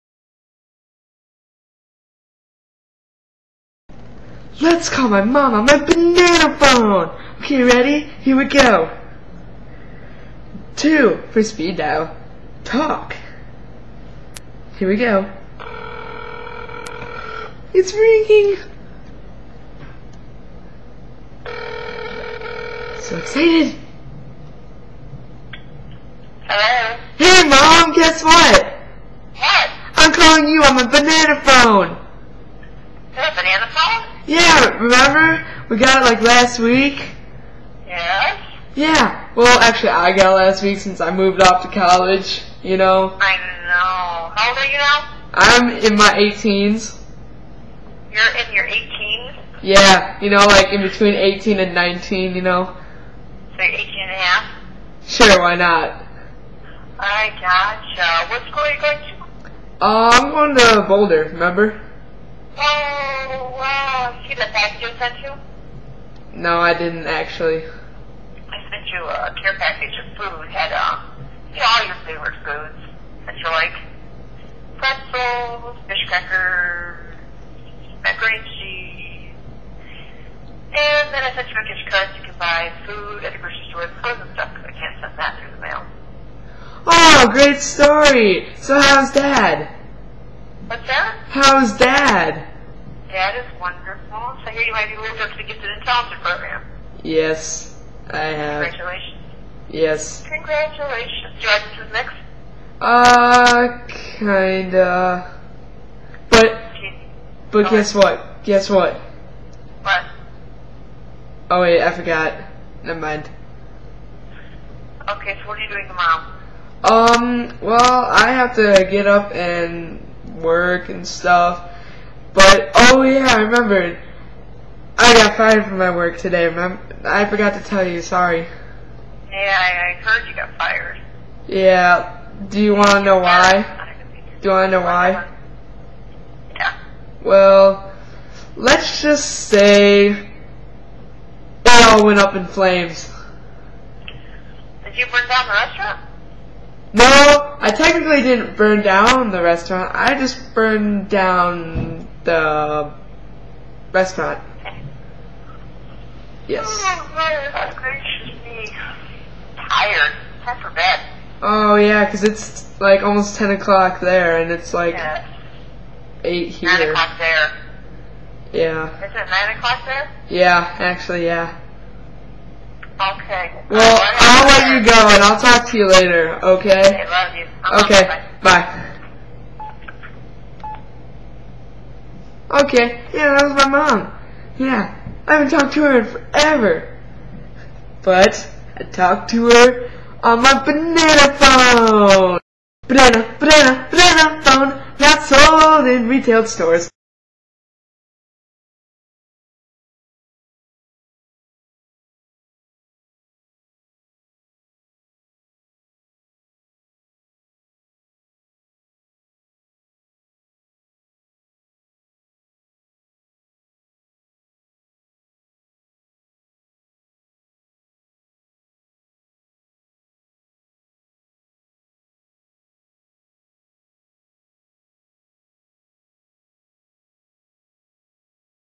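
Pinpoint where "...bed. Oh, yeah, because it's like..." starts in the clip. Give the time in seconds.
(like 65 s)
160 s.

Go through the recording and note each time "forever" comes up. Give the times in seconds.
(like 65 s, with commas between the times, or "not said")
186 s.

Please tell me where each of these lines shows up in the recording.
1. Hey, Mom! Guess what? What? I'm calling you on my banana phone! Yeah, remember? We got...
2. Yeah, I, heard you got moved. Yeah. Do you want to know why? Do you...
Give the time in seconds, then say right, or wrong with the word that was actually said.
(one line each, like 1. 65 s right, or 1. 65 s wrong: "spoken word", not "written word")
1. 27 s right
2. 129 s wrong: "fired", not "moved".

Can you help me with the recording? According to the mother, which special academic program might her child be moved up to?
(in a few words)
Gifted and Talented.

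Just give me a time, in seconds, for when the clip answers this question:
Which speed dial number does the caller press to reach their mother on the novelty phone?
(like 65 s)
10 s.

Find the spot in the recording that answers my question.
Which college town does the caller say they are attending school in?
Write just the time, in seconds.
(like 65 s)
60 s.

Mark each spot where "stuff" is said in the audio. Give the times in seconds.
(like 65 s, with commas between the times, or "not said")
84 s, 121 s.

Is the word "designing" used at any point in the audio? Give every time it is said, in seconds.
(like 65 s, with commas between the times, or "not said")
not said.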